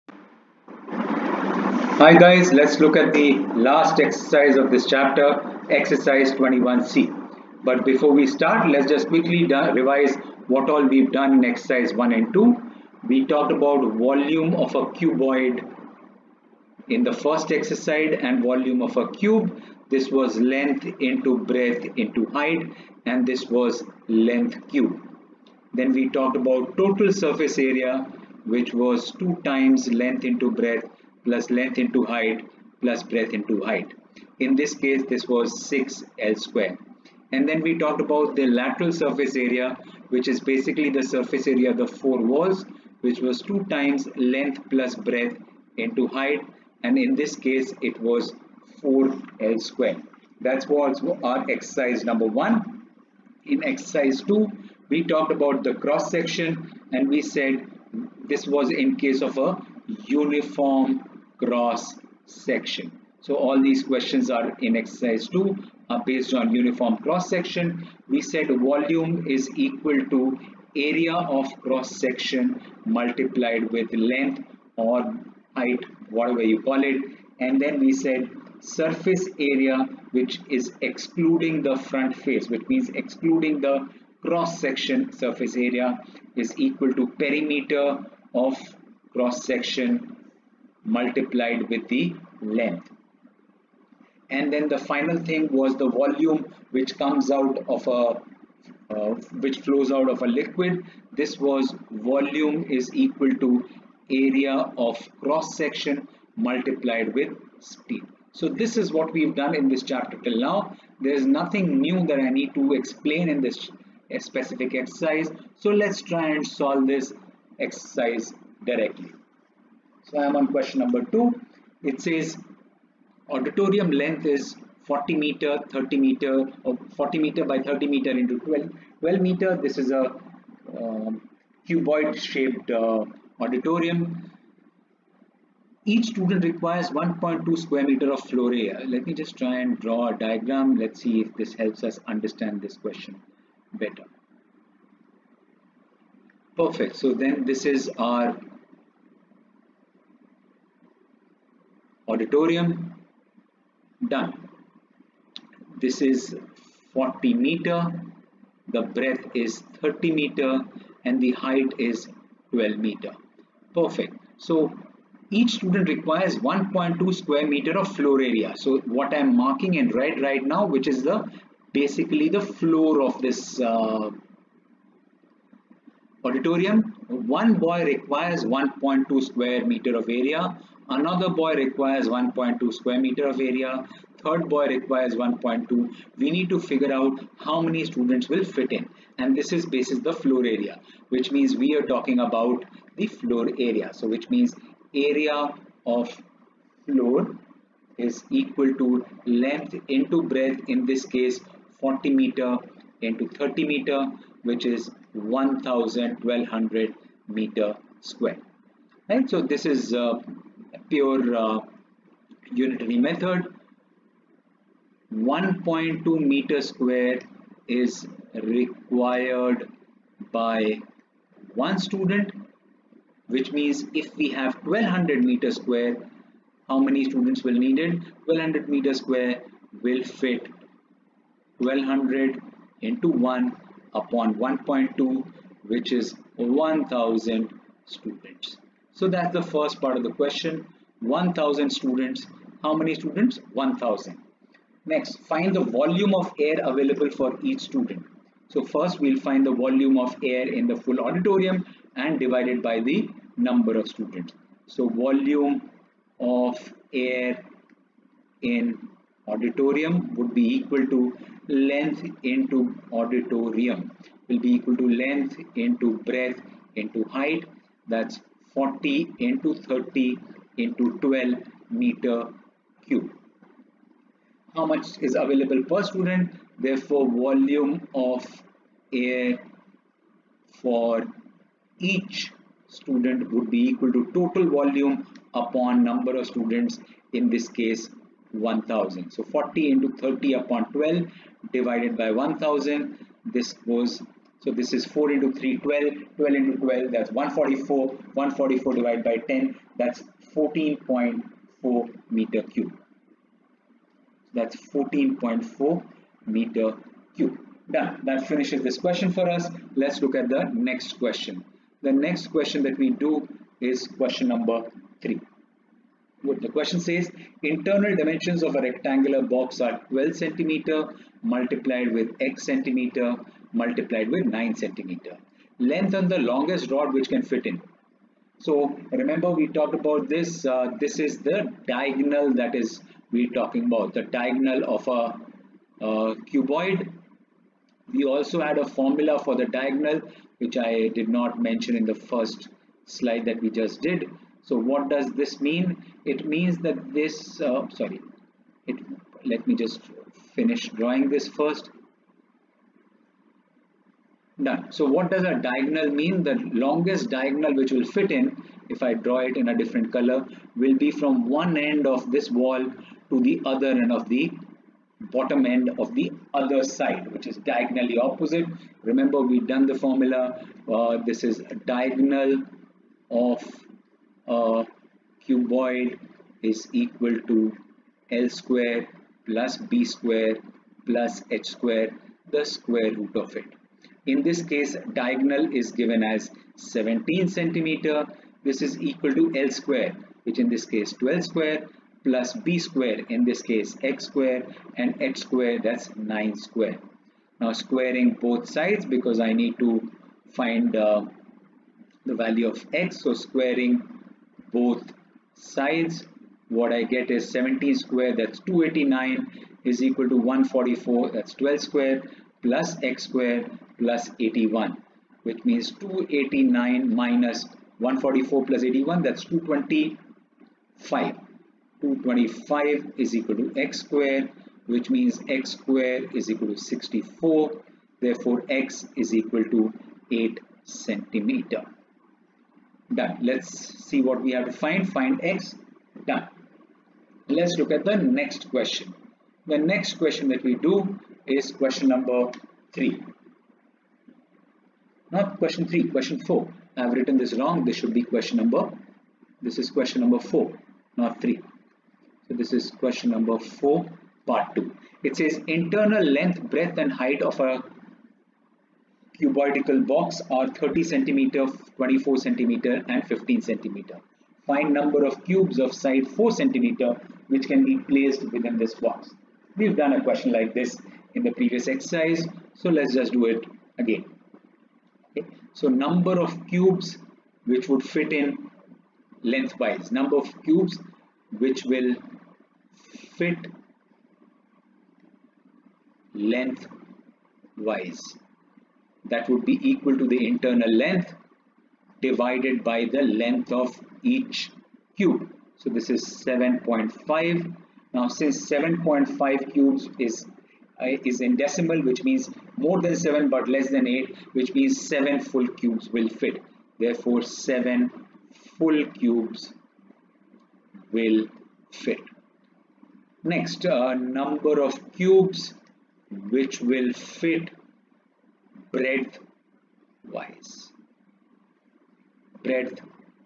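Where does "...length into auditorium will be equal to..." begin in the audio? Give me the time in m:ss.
4:21.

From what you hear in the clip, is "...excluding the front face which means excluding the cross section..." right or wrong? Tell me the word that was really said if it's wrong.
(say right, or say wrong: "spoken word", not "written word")
right.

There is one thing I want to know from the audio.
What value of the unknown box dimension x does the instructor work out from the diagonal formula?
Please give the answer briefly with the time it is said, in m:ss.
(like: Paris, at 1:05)
8 centimeters, at 7:10.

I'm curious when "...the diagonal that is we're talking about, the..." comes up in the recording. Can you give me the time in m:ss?
5:31.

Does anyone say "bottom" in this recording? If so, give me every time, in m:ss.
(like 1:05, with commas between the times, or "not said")
6:05.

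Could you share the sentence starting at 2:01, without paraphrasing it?
It says auditorium length is 40 meter, 30 meter, or 40 meter by 30 meter into 12, 12 meter.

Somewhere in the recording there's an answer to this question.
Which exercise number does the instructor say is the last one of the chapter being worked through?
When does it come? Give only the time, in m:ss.
0:05.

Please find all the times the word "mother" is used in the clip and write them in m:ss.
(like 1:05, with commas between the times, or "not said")
not said.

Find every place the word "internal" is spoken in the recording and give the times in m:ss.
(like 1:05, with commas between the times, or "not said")
5:17, 7:35, 8:10.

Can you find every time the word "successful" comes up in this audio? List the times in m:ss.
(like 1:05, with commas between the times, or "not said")
not said.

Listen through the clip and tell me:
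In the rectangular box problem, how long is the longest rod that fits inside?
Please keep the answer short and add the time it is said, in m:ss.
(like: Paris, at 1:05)
17 centimeters, at 6:26.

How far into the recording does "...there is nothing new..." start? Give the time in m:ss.
1:50.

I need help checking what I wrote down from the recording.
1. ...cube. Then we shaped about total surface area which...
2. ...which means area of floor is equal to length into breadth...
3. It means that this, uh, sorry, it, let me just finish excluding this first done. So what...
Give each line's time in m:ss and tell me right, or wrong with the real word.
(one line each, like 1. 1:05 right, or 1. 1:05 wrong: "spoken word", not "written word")
1. 0:24 wrong: "talked", not "shaped"
2. 3:14 right
3. 5:46 wrong: "drawing", not "excluding".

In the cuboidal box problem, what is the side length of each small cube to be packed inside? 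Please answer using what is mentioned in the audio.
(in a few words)
4 centimeters.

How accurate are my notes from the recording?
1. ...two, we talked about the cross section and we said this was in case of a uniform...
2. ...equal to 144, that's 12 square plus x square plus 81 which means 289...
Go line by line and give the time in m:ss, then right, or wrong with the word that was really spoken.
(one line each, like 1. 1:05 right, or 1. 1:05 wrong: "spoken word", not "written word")
1. 0:54 right
2. 6:49 right.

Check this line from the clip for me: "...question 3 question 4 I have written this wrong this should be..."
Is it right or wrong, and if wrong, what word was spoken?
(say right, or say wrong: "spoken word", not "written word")
right.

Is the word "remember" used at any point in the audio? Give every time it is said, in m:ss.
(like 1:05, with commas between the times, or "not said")
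5:28, 6:08.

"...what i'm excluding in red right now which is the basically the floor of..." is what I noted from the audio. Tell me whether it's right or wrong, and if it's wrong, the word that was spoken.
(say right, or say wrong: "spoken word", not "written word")
wrong: "marking", not "excluding".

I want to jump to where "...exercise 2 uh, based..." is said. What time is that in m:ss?
1:04.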